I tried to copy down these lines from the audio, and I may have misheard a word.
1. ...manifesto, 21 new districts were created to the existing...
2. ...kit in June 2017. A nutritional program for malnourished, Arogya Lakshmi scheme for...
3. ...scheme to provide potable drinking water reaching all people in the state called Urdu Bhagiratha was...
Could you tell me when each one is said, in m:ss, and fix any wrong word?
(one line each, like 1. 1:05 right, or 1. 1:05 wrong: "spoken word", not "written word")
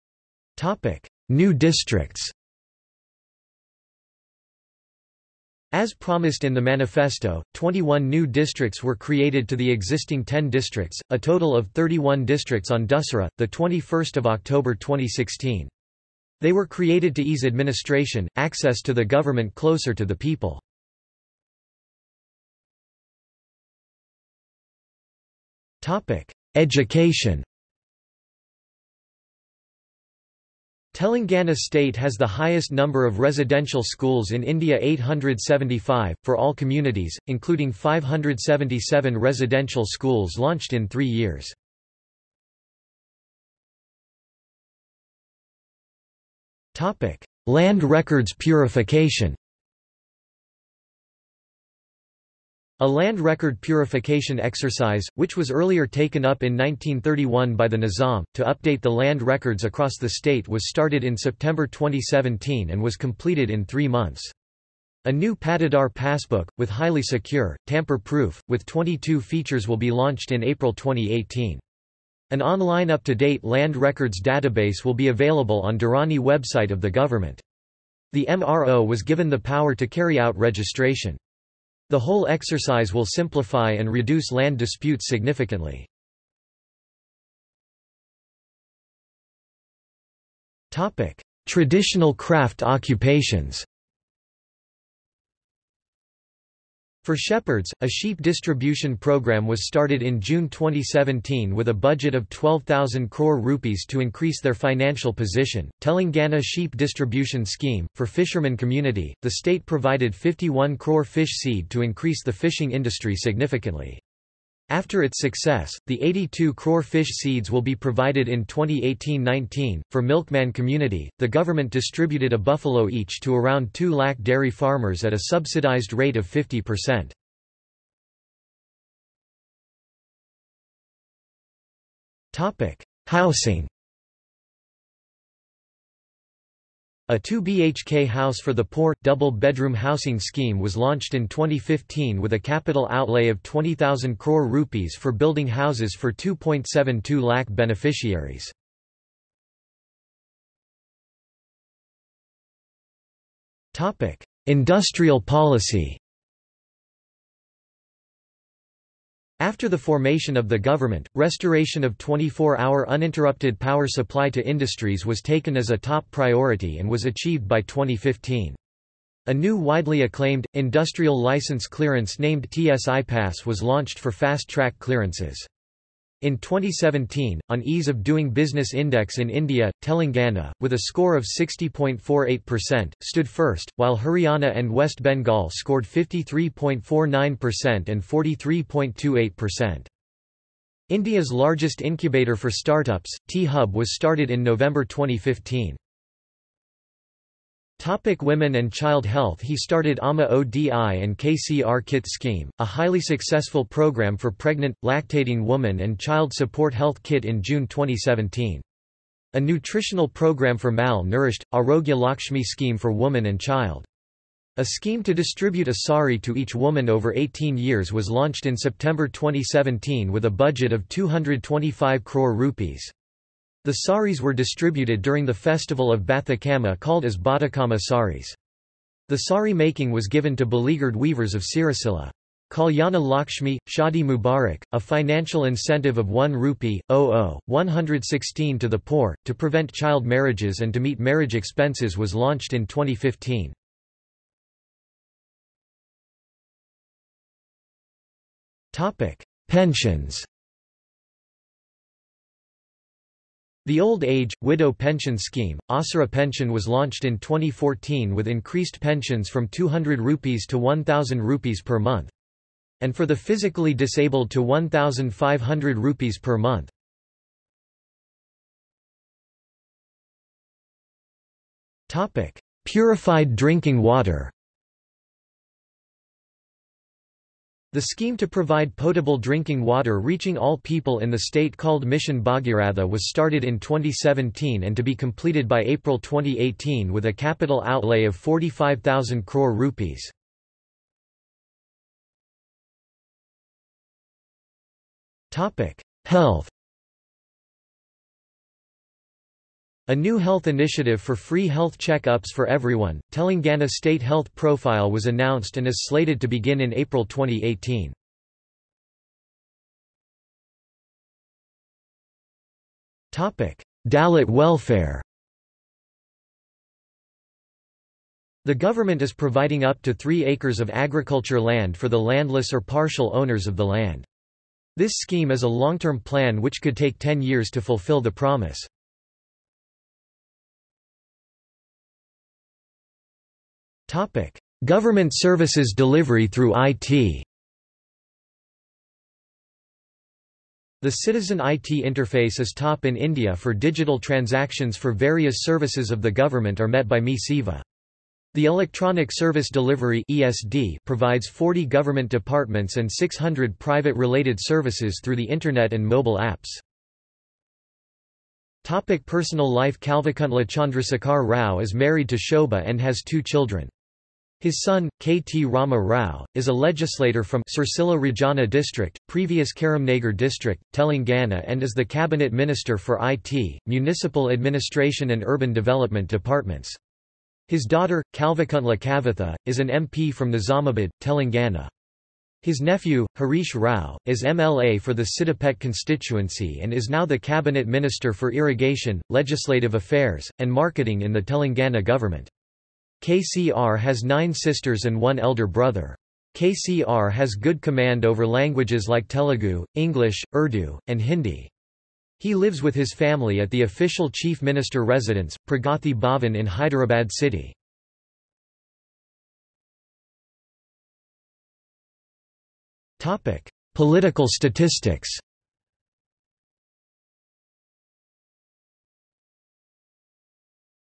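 1. 0:06 right
2. 3:27 right
3. 4:37 wrong: "Mission", not "Urdu".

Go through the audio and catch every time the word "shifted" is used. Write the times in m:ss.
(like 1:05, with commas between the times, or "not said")
not said.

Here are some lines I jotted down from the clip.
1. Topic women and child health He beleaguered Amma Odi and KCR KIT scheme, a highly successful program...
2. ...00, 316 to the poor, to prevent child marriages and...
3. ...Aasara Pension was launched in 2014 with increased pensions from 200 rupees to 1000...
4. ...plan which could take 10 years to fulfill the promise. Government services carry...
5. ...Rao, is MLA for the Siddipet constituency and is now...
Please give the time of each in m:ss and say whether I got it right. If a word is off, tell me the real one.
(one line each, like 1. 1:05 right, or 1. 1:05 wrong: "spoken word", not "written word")
1. 3:17 wrong: "started", not "beleaguered"
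2. 3:56 wrong: "116", not "316"
3. 4:15 right
4. 5:25 wrong: "delivery", not "carry"
5. 6:23 right.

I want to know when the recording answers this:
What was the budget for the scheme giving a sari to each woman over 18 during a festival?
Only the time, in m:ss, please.
3:40.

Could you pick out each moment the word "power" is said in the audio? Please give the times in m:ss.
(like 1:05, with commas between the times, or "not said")
1:19, 2:43.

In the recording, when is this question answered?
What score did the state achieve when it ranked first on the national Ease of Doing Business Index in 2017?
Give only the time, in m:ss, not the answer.
3:01.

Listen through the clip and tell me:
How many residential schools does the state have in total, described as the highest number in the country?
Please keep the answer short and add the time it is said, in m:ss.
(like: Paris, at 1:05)
875, at 0:34.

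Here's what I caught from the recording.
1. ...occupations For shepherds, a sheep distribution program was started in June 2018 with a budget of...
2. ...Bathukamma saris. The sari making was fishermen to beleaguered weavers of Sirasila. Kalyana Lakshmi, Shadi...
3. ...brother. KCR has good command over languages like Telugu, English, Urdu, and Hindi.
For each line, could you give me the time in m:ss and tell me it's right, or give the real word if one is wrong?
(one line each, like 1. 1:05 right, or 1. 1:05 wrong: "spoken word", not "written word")
1. 1:32 wrong: "2017", not "2018"
2. 3:47 wrong: "given", not "fishermen"
3. 6:35 right.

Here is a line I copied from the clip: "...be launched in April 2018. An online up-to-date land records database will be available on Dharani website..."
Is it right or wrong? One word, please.
right.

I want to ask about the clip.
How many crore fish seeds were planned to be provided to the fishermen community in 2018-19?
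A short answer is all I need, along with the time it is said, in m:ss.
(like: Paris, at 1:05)
82 crore, at 1:56.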